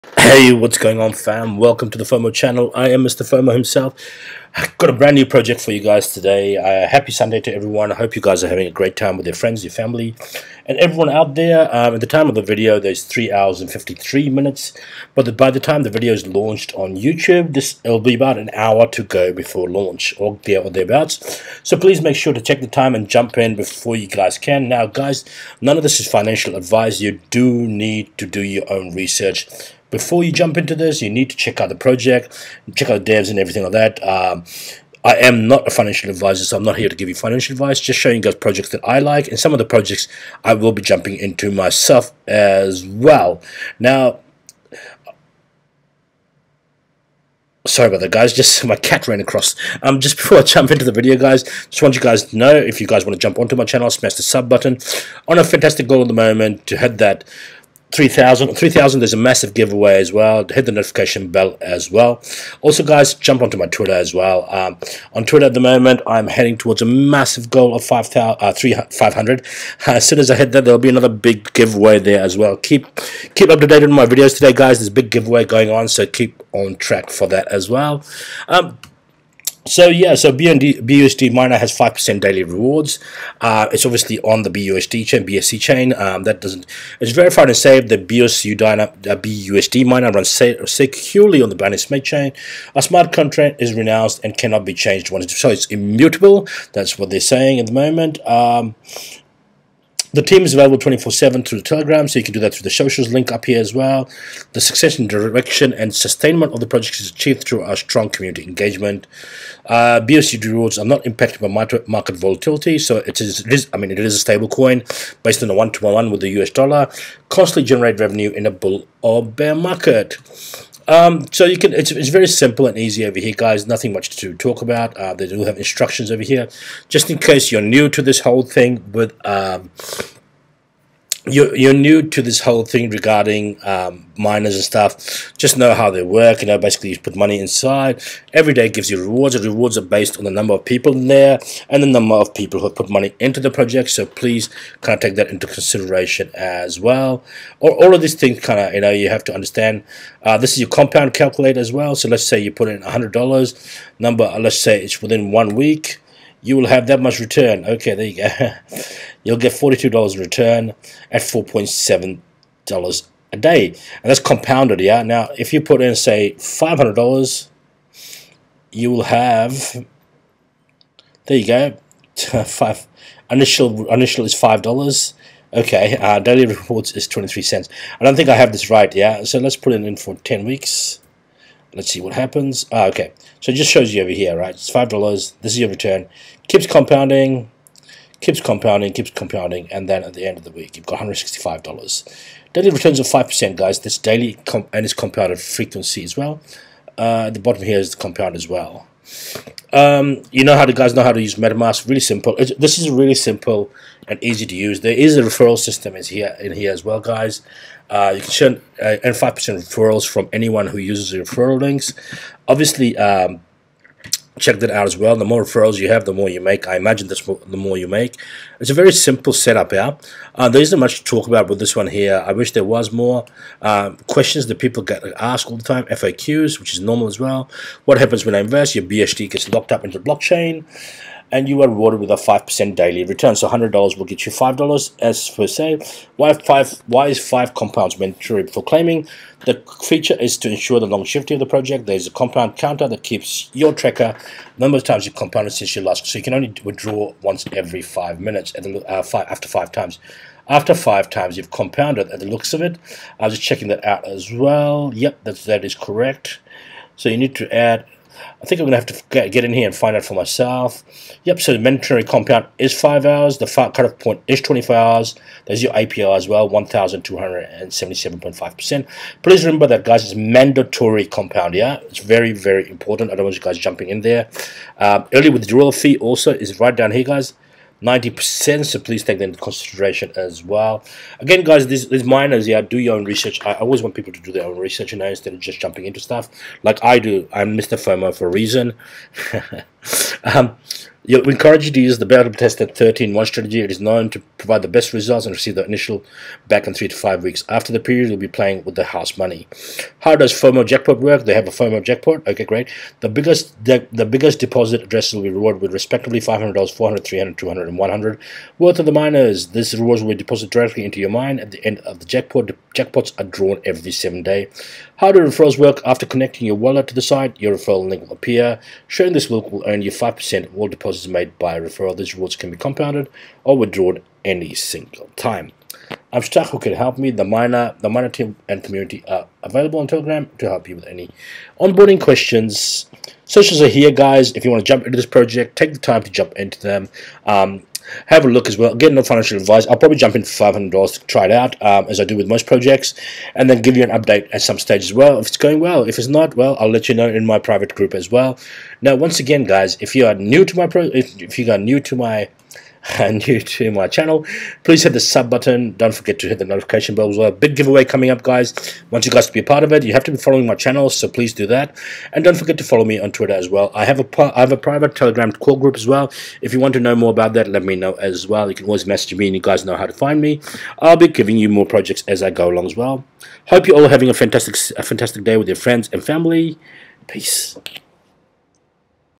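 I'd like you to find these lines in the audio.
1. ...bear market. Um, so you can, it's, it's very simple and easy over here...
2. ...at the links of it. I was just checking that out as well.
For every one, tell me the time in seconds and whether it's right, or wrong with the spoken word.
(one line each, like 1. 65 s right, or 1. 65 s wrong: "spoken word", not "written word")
1. 119 s right
2. 252 s wrong: "looks", not "links".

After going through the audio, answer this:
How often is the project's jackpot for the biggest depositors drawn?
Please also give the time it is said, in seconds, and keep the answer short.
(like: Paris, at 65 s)
Every 7 days, at 313 s.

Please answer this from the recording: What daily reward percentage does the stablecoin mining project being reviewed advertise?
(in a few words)
5%.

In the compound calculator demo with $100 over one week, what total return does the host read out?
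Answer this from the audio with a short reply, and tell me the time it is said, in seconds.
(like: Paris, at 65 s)
$42, at 159 s.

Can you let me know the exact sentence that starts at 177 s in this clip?
I don't think I have this right, yeah?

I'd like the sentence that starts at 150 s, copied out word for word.
Uh, this is your compound calculator as well.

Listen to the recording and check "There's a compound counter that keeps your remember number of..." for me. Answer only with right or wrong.
wrong.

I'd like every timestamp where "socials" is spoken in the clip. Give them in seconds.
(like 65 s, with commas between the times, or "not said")
102 s, 333 s.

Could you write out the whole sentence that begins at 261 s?
Yep, so the mandatory compound is 5 hours.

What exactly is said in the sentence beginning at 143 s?
So please kind of take that into consideration as well.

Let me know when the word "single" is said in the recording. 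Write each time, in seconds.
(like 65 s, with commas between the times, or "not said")
324 s.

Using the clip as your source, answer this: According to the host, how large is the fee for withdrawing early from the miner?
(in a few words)
90%.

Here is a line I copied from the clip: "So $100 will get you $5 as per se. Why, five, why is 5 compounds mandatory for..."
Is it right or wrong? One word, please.
right.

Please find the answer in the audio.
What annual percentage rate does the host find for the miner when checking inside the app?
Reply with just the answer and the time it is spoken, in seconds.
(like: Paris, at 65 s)
1,277.5%, at 266 s.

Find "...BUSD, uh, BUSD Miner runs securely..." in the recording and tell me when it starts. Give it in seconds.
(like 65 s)
87 s.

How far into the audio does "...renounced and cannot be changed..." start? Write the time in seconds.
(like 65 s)
93 s.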